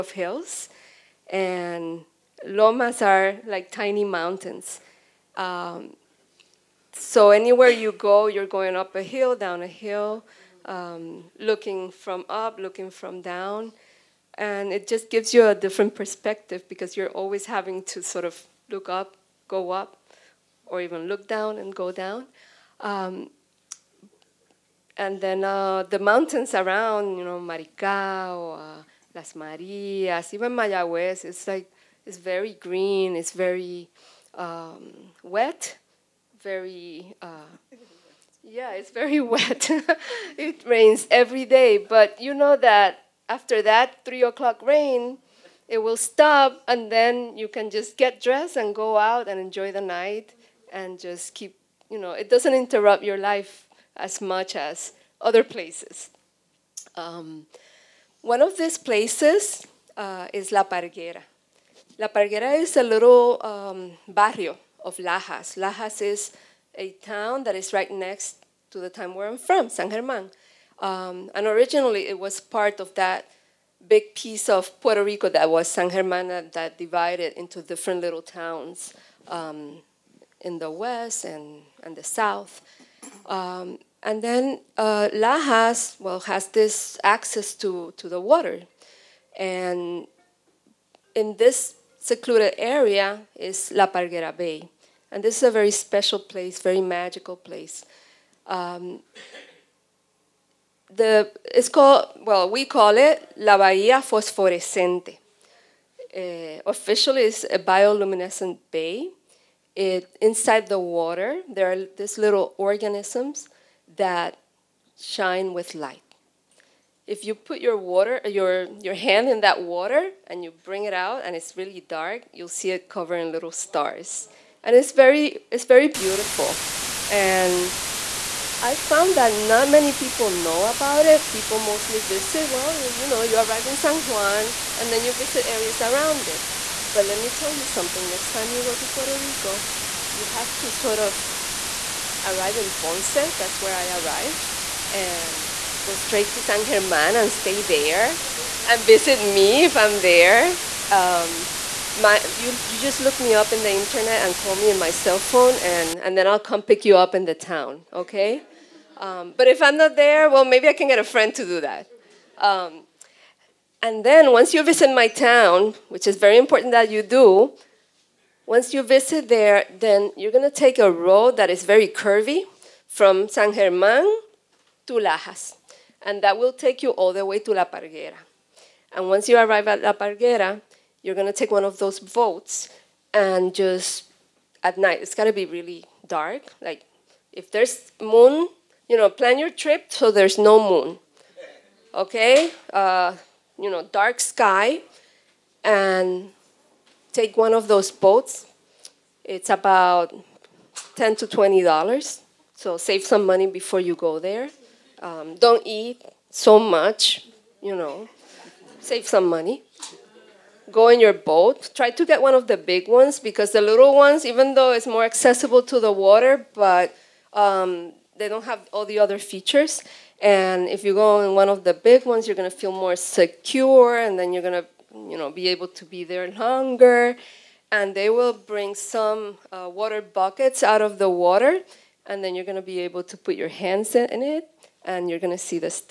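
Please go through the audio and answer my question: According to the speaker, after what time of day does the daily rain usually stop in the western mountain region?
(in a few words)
3 o'clock.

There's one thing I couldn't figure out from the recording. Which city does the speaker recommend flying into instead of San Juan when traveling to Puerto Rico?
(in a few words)
Ponce.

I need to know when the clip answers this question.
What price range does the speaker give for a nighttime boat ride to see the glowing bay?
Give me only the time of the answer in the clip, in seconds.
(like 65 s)
200 s.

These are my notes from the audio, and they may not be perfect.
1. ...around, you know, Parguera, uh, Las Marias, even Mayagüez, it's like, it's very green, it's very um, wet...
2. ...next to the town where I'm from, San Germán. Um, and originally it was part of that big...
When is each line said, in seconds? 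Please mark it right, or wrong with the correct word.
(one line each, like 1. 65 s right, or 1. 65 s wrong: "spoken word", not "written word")
1. 26 s wrong: "Maricao", not "Parguera"
2. 67 s right.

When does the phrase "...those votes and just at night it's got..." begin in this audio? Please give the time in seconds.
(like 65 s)
181 s.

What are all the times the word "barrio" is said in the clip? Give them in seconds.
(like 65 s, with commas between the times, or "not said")
64 s.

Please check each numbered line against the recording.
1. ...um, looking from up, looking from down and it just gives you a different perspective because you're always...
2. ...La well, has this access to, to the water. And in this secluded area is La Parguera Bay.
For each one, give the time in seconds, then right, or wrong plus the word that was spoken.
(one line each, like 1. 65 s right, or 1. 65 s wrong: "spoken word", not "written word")
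1. 10 s right
2. 85 s right.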